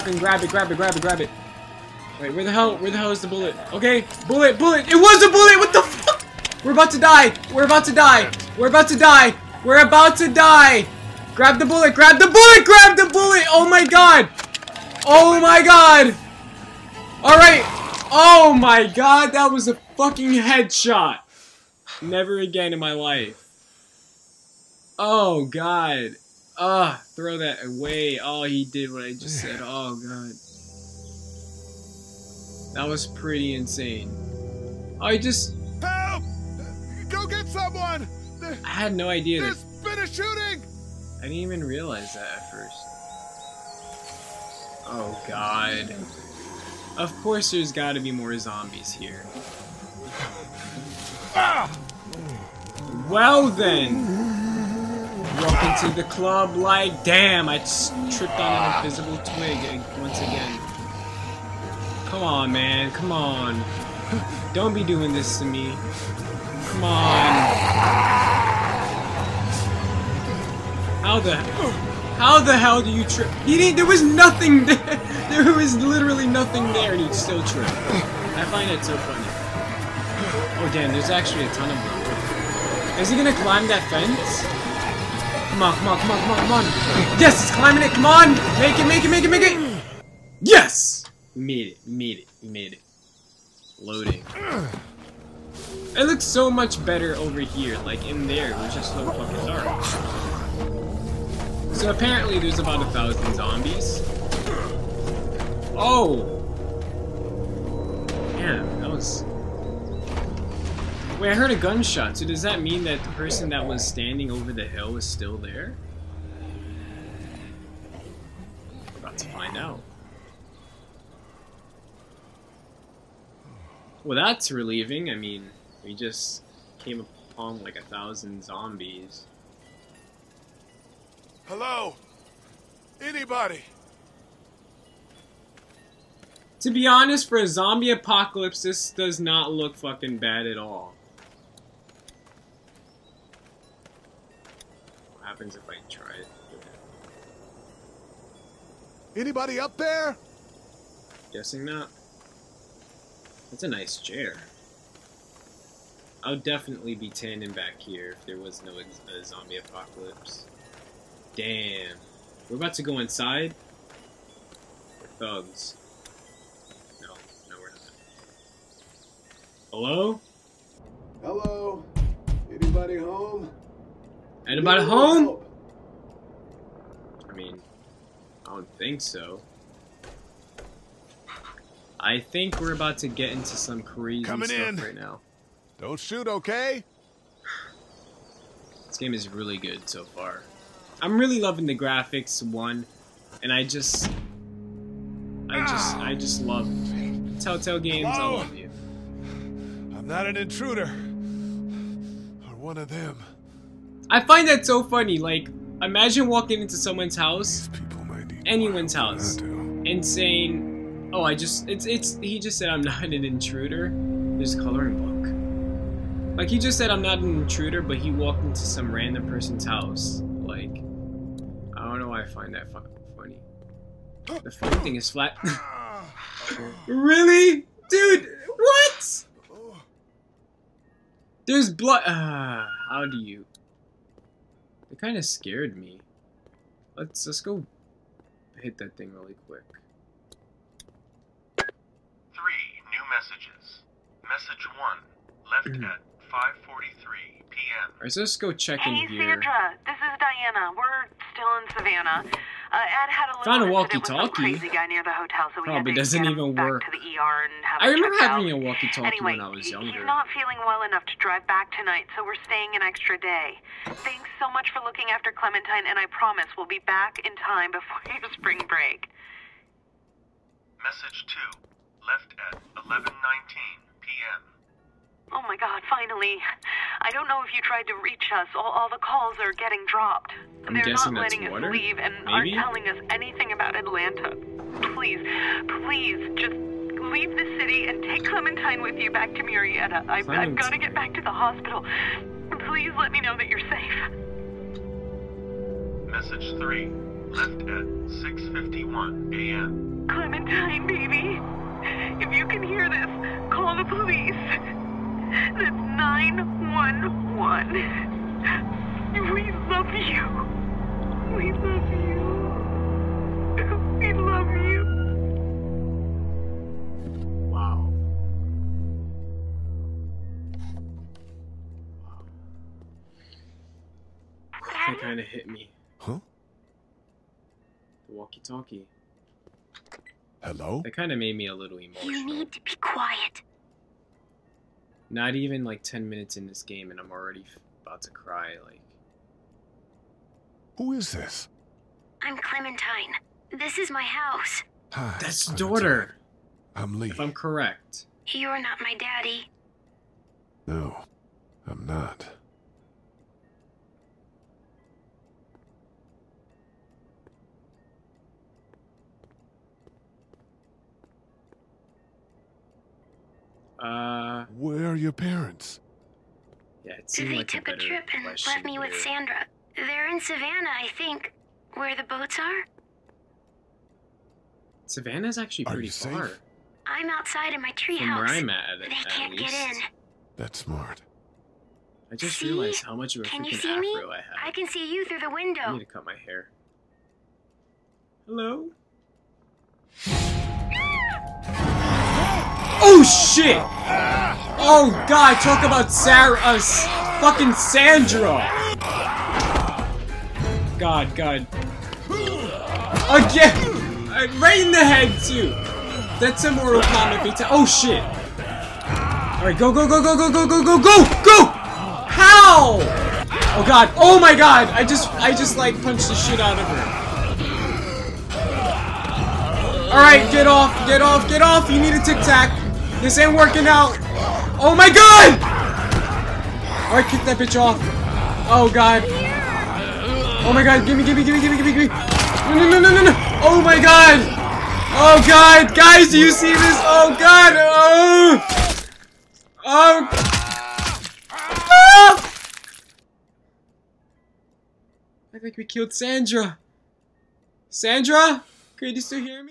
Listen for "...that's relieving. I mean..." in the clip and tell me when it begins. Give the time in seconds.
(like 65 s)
124 s.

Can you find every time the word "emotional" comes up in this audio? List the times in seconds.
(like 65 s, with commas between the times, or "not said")
331 s.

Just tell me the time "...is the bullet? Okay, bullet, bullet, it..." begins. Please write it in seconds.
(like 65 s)
3 s.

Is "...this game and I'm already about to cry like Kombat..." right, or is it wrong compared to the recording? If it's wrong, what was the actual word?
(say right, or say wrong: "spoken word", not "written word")
wrong: "Who", not "Kombat".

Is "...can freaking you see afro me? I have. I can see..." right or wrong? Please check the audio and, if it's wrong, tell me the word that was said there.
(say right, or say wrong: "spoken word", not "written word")
right.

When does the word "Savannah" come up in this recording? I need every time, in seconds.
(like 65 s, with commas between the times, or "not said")
251 s, 370 s, 374 s.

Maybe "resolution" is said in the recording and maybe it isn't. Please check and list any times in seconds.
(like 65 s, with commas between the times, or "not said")
not said.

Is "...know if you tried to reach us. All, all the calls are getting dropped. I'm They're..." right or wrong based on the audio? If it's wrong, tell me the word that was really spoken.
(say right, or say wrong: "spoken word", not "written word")
right.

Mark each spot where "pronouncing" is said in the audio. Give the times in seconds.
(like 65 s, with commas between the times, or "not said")
not said.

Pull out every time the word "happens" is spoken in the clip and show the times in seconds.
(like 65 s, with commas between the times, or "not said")
145 s.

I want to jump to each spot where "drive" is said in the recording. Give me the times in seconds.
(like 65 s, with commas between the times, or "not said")
261 s.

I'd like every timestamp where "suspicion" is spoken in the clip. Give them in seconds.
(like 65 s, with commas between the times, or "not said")
not said.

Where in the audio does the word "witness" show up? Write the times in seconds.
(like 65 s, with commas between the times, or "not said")
not said.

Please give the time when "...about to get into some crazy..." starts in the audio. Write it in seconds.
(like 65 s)
182 s.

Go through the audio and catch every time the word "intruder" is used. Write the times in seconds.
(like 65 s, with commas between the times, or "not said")
200 s, 213 s, 217 s.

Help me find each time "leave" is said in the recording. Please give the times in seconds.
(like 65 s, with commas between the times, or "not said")
281 s, 287 s.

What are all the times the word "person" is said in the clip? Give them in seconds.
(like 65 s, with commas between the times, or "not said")
113 s, 219 s.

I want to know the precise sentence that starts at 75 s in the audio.
There was literally nothing there and he still tripped.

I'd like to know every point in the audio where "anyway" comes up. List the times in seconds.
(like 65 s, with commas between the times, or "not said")
259 s.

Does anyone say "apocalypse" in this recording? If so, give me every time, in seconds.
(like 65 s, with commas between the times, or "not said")
137 s, 159 s.